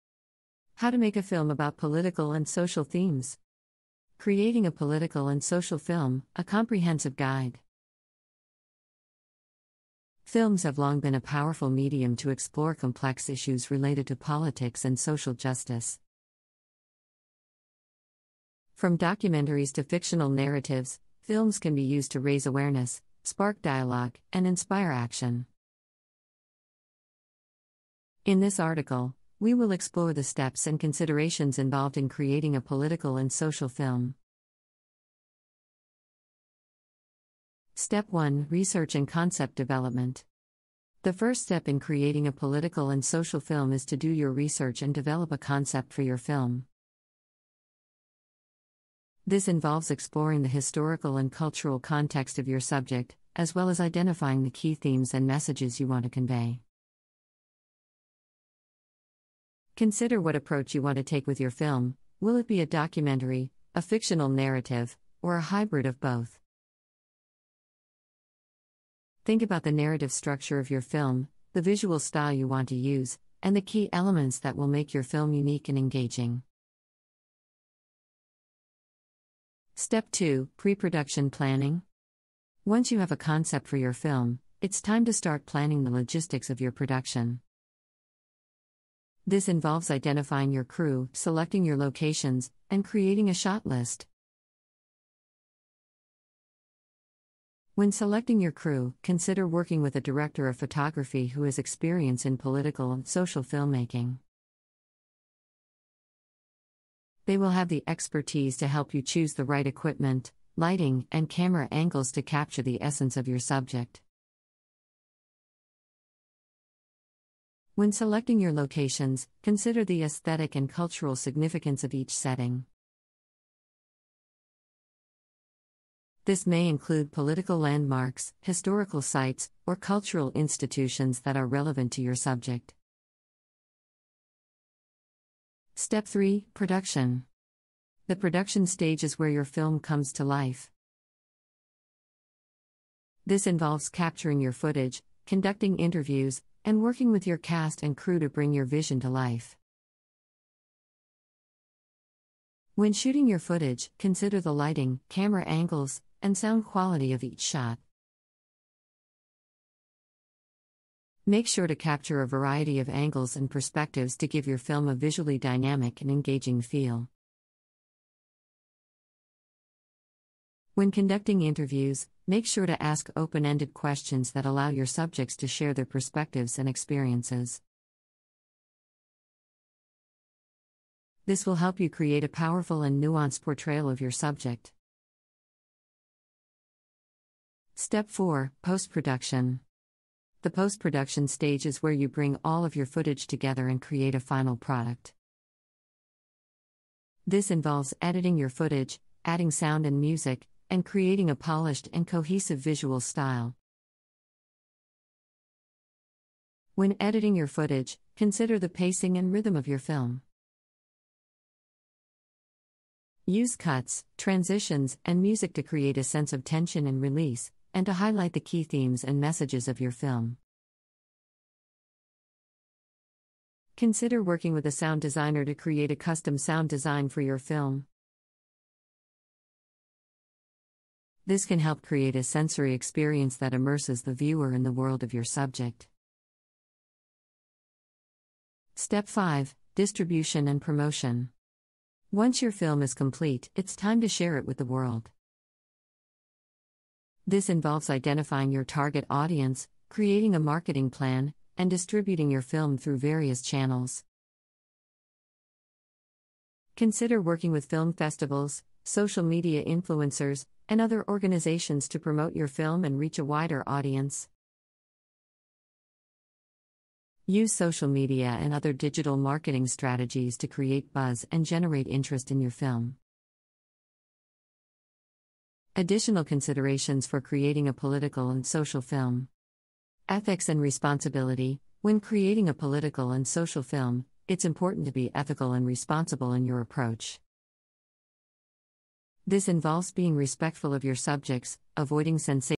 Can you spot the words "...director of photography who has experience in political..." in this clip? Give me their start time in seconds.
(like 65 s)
100 s.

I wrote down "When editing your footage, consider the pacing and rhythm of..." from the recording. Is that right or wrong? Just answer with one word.
right.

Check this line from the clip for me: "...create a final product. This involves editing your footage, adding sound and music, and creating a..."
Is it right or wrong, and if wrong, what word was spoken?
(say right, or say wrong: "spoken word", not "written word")
right.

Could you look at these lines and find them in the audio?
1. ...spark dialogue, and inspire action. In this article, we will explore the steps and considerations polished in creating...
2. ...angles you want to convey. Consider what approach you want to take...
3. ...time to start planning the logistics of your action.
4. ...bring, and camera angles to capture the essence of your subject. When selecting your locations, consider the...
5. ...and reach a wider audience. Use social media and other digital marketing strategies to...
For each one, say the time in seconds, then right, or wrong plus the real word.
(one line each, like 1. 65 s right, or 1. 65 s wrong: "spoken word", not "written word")
1. 23 s wrong: "involved", not "polished"
2. 55 s wrong: "messages", not "angles"
3. 84 s wrong: "production", not "action"
4. 110 s wrong: "lighting", not "bring"
5. 262 s right.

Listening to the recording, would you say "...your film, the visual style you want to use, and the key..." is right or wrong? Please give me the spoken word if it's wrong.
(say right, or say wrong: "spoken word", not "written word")
right.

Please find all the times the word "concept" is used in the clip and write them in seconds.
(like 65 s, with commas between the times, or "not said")
39 s, 45 s, 83 s.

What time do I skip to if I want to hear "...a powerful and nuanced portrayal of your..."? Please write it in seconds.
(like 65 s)
182 s.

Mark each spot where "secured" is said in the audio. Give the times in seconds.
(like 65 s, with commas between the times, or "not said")
not said.